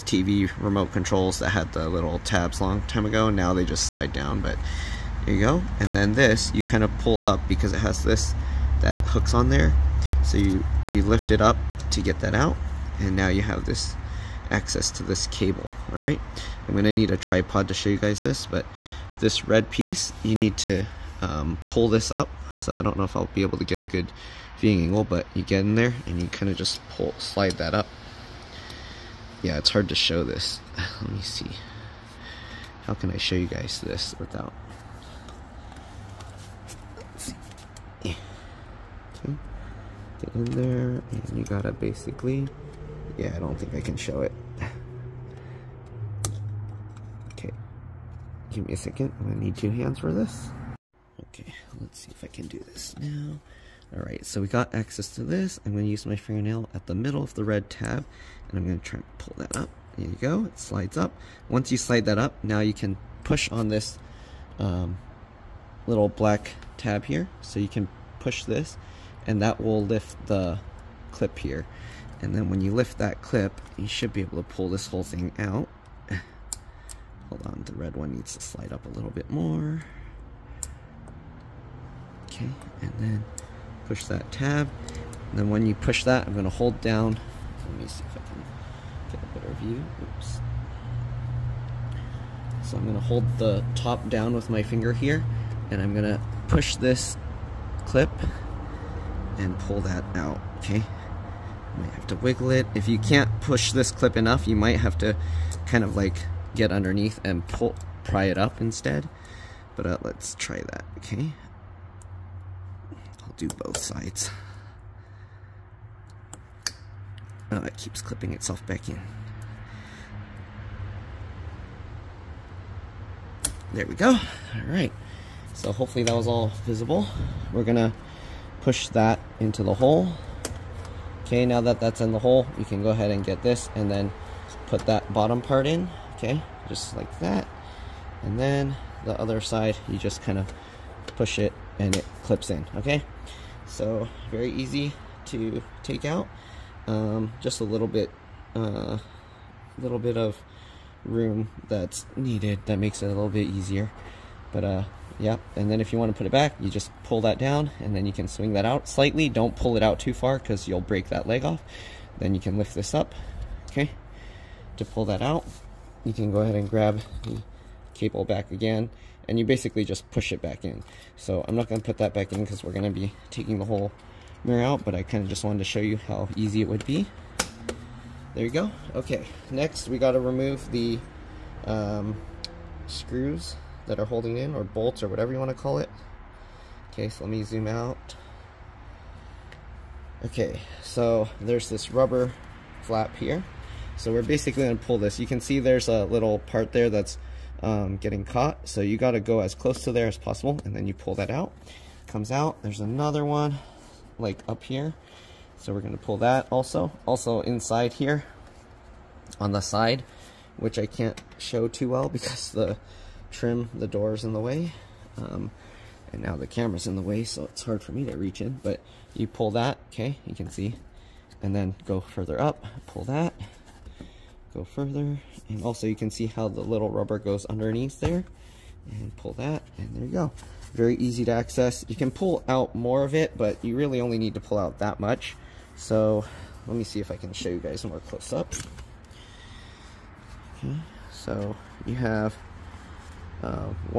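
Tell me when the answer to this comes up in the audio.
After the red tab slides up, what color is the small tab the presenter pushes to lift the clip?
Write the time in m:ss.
1:06.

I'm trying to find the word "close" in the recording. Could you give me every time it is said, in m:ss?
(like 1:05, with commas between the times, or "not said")
3:19, 3:57.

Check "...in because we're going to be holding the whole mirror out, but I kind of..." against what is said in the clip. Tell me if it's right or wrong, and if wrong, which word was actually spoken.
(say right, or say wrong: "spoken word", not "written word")
wrong: "taking", not "holding".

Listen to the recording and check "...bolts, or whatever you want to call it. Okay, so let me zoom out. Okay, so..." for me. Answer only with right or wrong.
right.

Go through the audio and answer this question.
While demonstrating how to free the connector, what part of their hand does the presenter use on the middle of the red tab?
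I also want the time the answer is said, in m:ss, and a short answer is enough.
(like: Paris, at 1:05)
fingernail, at 0:56.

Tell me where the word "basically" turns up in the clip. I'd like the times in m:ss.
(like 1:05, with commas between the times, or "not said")
0:41, 2:49, 3:14.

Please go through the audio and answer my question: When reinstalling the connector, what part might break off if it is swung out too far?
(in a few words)
leg.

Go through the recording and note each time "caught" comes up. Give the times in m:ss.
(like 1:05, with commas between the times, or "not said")
3:18.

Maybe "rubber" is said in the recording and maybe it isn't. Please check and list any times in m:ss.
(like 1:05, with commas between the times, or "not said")
3:11, 3:46.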